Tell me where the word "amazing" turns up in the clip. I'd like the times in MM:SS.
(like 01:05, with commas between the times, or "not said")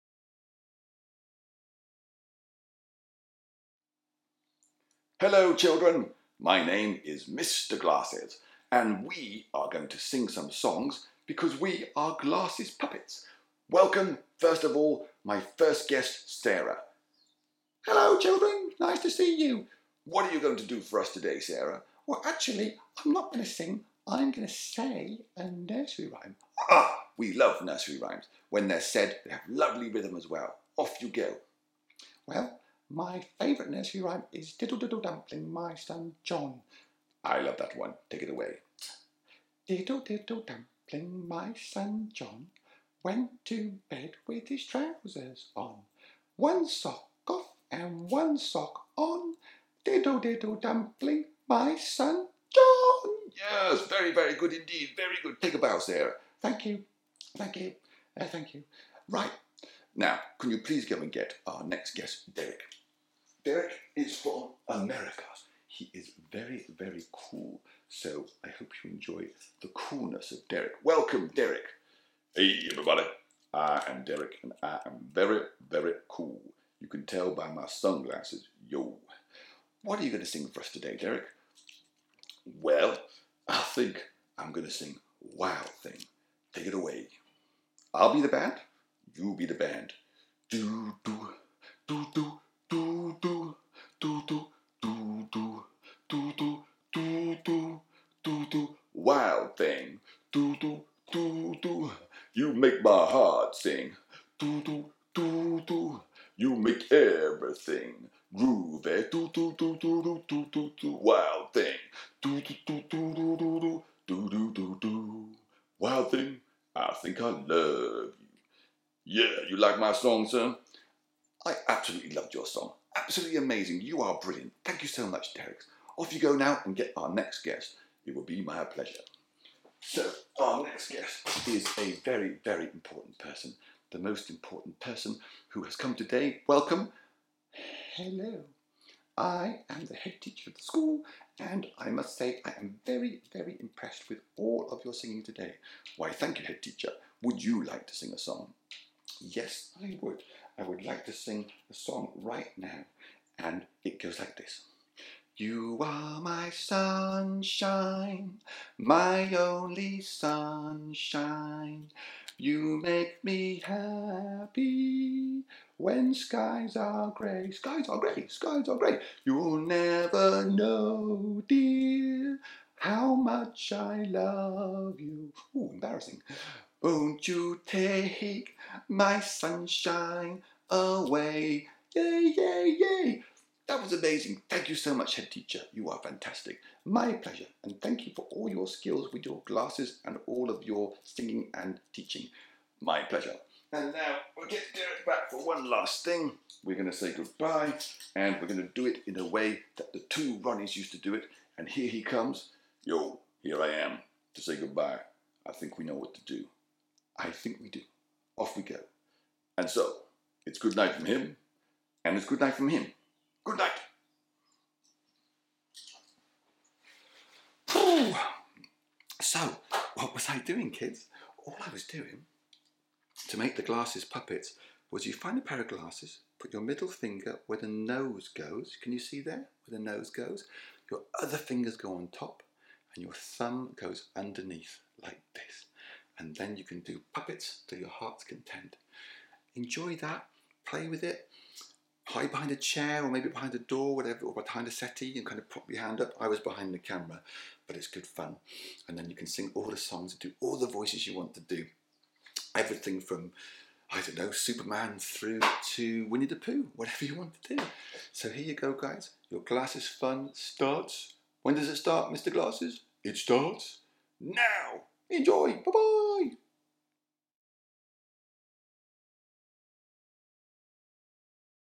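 02:03, 03:03.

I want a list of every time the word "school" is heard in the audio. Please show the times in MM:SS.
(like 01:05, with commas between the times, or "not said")
02:20.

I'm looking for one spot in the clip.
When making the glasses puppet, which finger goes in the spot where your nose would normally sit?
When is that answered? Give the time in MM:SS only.
03:46.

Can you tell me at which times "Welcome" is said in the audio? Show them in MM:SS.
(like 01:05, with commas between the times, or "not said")
00:13, 01:10, 02:16.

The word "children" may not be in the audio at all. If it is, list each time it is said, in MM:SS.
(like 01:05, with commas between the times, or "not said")
00:05, 00:18.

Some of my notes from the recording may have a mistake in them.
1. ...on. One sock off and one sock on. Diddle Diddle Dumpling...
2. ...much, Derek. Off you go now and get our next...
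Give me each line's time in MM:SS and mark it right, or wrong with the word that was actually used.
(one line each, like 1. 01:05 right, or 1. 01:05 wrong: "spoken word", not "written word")
1. 00:45 right
2. 02:05 right.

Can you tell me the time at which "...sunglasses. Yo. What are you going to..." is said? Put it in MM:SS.
01:17.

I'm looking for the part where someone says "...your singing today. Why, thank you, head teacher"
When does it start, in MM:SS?
02:24.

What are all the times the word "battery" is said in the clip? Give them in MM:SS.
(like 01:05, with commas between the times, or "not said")
not said.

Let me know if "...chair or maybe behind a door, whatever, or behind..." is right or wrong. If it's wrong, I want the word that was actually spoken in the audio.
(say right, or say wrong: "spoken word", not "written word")
right.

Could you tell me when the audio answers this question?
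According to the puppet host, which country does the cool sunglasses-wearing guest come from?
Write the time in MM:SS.
01:04.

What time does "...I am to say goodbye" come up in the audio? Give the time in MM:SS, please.
03:23.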